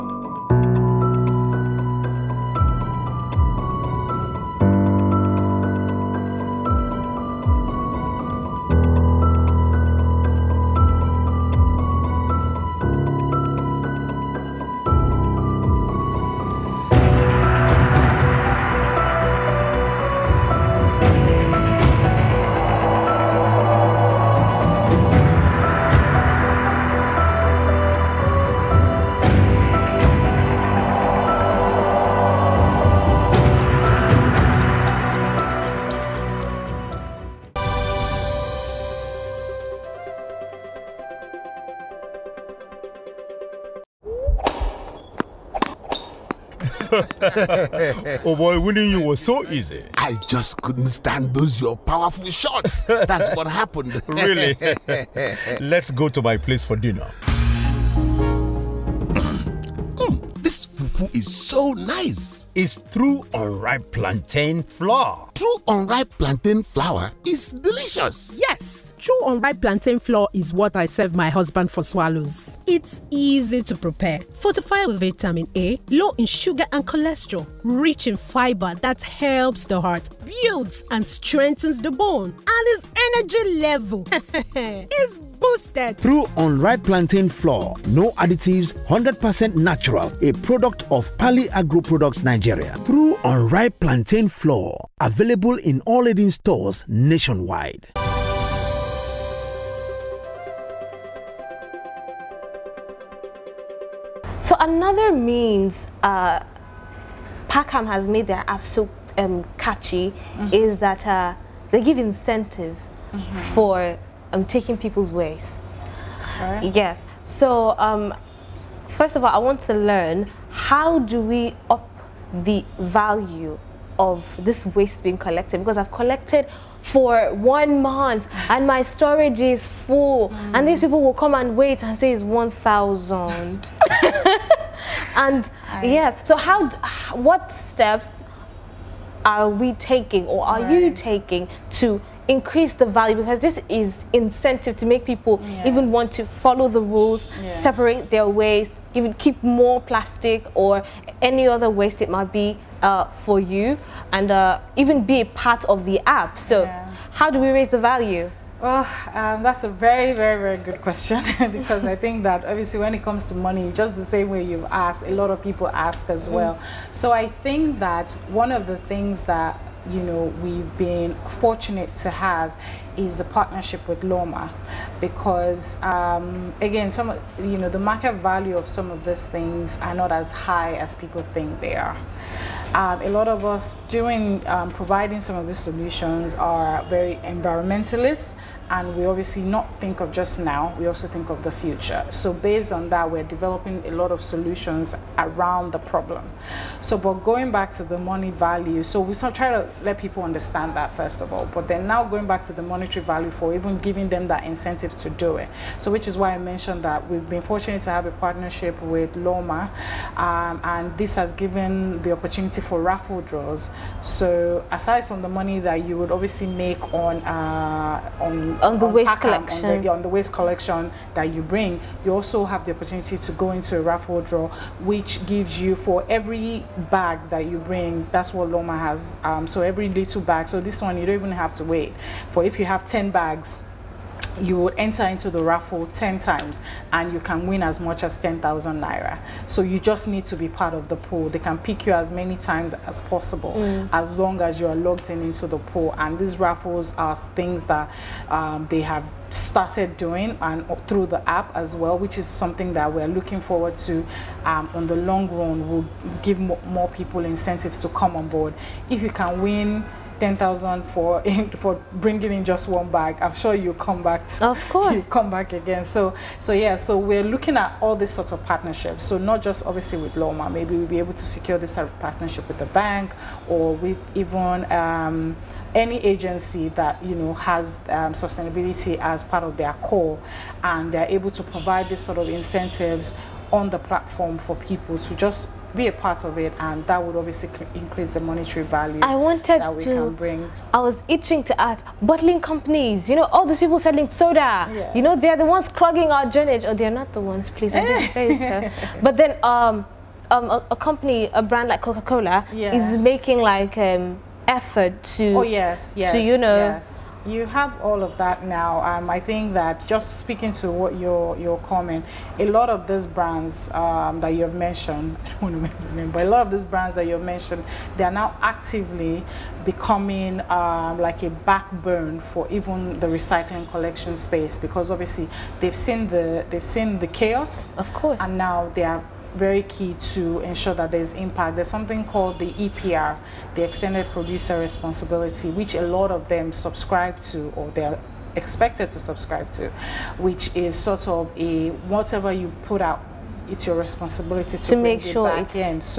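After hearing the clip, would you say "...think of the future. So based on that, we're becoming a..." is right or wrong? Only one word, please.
wrong.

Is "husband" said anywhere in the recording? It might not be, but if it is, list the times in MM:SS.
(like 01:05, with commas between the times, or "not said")
01:11.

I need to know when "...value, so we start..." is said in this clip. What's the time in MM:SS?
03:18.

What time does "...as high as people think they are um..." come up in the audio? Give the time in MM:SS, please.
03:00.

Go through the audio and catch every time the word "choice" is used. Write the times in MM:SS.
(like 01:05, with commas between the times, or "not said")
not said.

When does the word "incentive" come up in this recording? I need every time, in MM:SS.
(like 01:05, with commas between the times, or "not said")
01:52, 02:24, 03:24, 04:17, 04:42.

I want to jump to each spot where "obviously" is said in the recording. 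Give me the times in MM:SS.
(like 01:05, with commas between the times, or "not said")
02:42, 03:09, 03:36, 04:29, 04:47, 05:24.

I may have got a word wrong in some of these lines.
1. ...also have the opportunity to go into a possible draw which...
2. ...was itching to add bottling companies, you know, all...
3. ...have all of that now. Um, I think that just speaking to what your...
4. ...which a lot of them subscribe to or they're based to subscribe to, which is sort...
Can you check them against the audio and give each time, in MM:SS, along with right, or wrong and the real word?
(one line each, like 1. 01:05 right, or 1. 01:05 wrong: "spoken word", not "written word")
1. 03:42 wrong: "raffle", not "possible"
2. 04:50 right
3. 05:07 right
4. 05:35 wrong: "expected", not "based".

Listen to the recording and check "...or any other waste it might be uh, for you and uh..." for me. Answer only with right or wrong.
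right.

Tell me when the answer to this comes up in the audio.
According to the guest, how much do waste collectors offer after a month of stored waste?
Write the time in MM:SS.
02:12.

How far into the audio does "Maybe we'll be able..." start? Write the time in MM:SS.
04:30.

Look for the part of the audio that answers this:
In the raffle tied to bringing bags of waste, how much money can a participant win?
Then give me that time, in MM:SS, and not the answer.
03:58.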